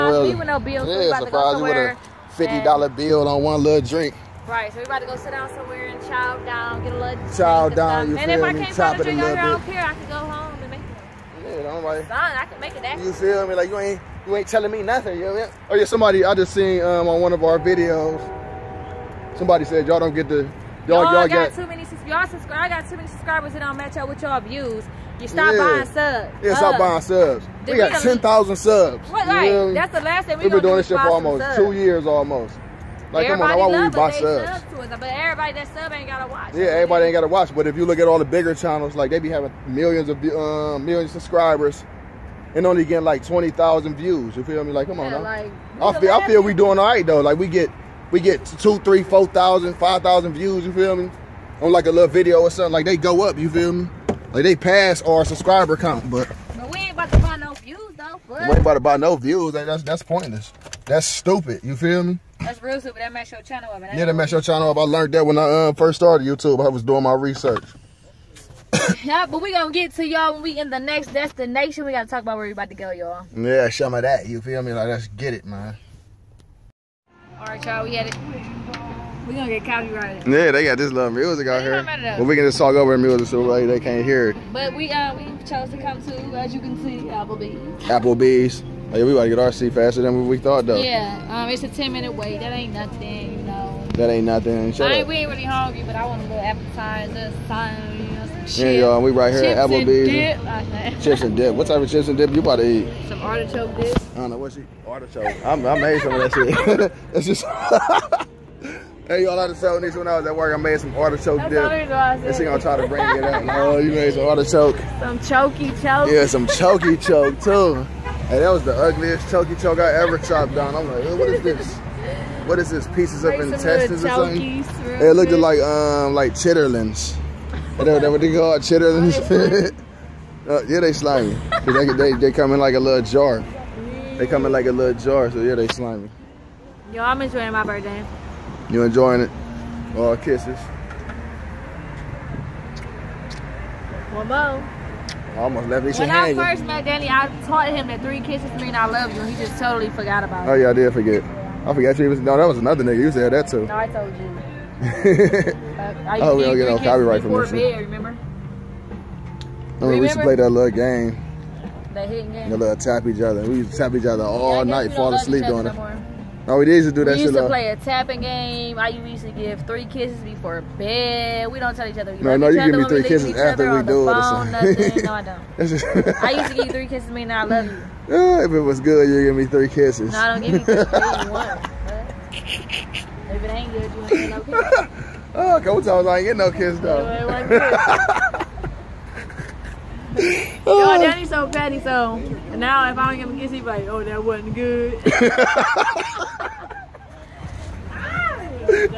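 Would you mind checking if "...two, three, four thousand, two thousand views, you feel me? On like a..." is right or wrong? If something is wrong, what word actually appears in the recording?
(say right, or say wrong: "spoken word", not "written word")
wrong: "five", not "two".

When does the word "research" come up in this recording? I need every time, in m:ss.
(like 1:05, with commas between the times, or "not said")
1:07.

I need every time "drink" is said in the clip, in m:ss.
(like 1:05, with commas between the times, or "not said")
0:03, 0:09.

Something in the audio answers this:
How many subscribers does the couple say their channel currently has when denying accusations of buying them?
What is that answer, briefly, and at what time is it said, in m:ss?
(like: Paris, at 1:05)
10,000, at 0:28.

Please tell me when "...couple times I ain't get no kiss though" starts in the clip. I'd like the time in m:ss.
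3:05.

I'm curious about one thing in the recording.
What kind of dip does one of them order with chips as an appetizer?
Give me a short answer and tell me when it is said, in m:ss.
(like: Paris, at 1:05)
Artichoke dip, at 1:43.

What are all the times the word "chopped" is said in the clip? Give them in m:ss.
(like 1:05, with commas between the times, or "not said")
2:00.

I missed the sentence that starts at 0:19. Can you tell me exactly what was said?
Somebody said y'all don't get the y'all y'all, got, got, too many y'all subscribe.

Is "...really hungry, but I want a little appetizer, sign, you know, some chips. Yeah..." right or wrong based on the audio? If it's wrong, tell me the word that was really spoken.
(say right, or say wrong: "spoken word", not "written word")
right.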